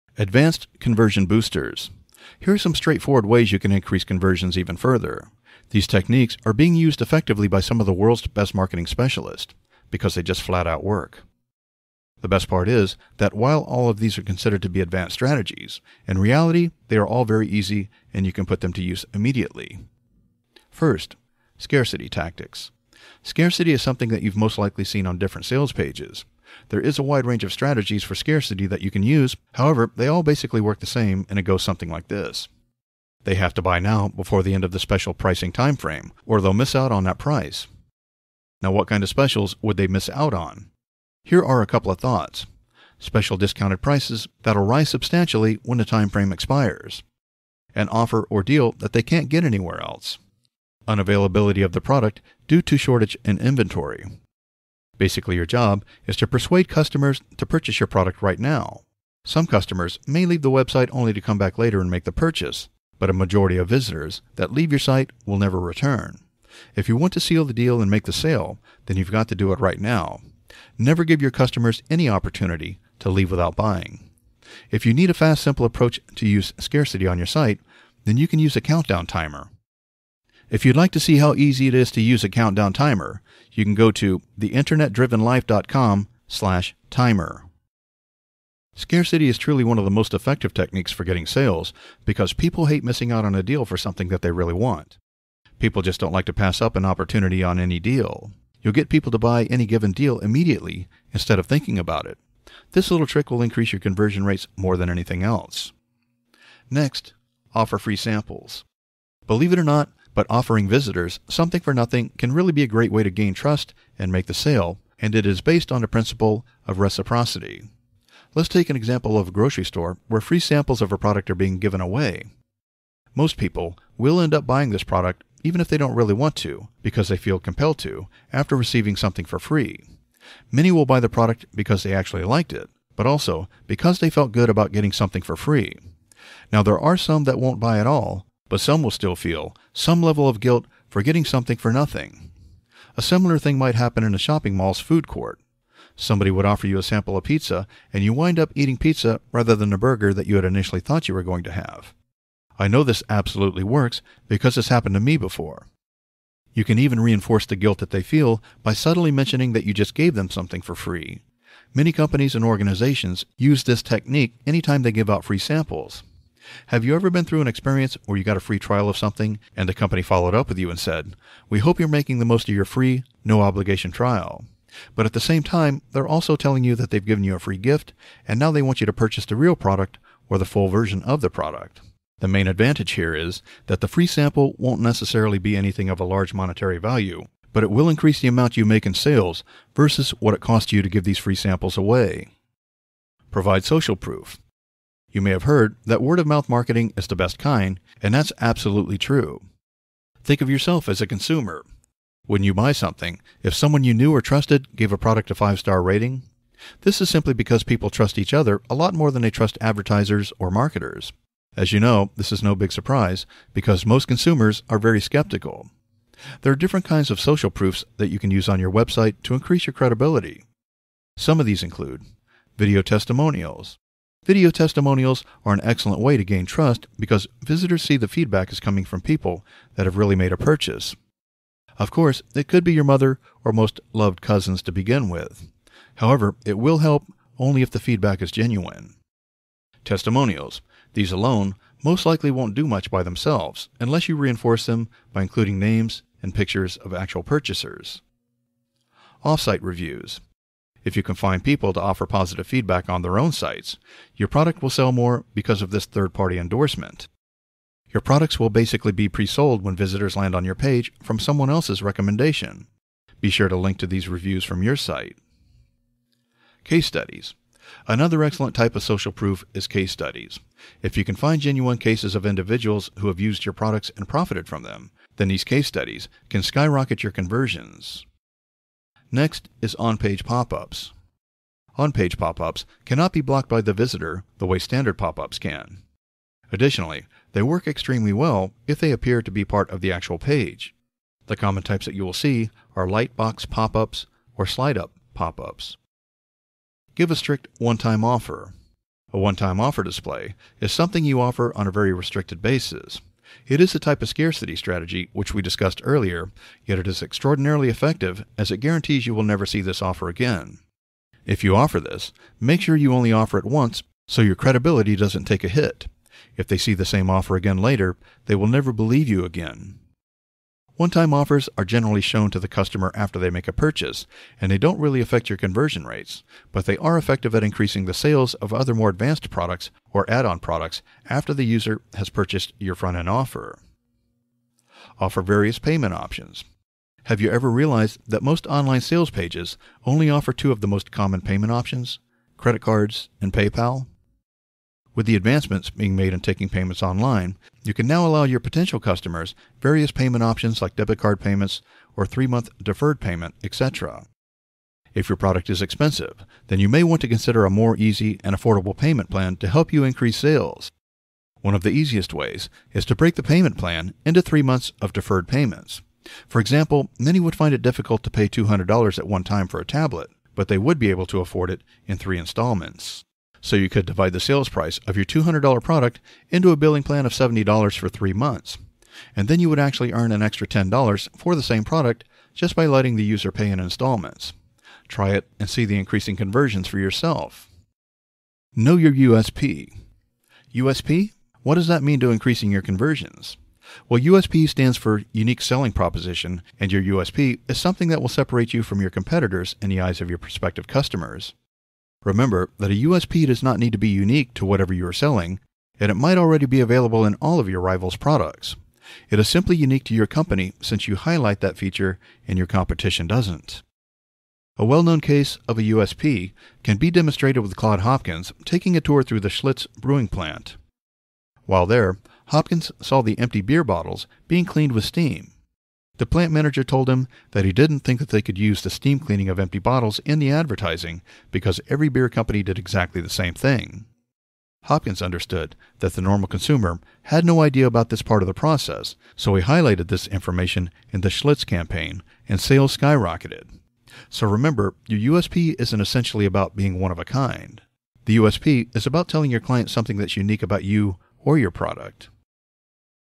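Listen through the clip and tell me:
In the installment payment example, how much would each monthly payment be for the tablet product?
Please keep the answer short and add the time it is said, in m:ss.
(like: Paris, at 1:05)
$70, at 6:17.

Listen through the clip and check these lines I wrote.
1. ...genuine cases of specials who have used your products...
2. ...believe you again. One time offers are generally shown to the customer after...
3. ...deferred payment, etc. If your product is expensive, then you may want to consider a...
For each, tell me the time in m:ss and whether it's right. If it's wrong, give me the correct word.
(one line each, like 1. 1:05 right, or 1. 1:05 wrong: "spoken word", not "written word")
1. 4:31 wrong: "individuals", not "specials"
2. 5:18 right
3. 5:52 right.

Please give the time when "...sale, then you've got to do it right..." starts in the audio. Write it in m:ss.
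1:08.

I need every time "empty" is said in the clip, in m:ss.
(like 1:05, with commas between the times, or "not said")
7:03, 7:09.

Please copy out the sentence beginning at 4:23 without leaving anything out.
Be sure to link to these reviews from your site.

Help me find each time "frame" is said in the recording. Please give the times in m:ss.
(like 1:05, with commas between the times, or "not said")
0:35, 0:46.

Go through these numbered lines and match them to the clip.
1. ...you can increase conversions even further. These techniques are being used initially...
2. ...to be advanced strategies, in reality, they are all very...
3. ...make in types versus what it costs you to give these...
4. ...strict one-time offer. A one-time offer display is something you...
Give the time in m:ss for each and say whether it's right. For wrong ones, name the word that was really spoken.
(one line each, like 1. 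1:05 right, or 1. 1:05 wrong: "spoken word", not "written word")
1. 0:03 wrong: "effectively", not "initially"
2. 0:14 right
3. 3:08 wrong: "sales", not "types"
4. 4:57 right.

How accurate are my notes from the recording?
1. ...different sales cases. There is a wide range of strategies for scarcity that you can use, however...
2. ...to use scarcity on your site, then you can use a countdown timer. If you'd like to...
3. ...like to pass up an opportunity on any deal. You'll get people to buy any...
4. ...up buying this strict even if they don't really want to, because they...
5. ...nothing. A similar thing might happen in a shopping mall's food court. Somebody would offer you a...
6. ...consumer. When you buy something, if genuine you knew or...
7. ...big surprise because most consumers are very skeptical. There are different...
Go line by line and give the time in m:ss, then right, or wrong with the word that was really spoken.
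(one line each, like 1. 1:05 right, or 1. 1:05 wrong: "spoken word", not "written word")
1. 0:25 wrong: "pages", not "cases"
2. 1:16 right
3. 1:36 right
4. 2:04 wrong: "product", not "strict"
5. 2:21 right
6. 3:21 wrong: "someone", not "genuine"
7. 3:32 right.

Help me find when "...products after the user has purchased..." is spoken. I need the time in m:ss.
5:30.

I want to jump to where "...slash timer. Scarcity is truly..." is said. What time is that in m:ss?
1:26.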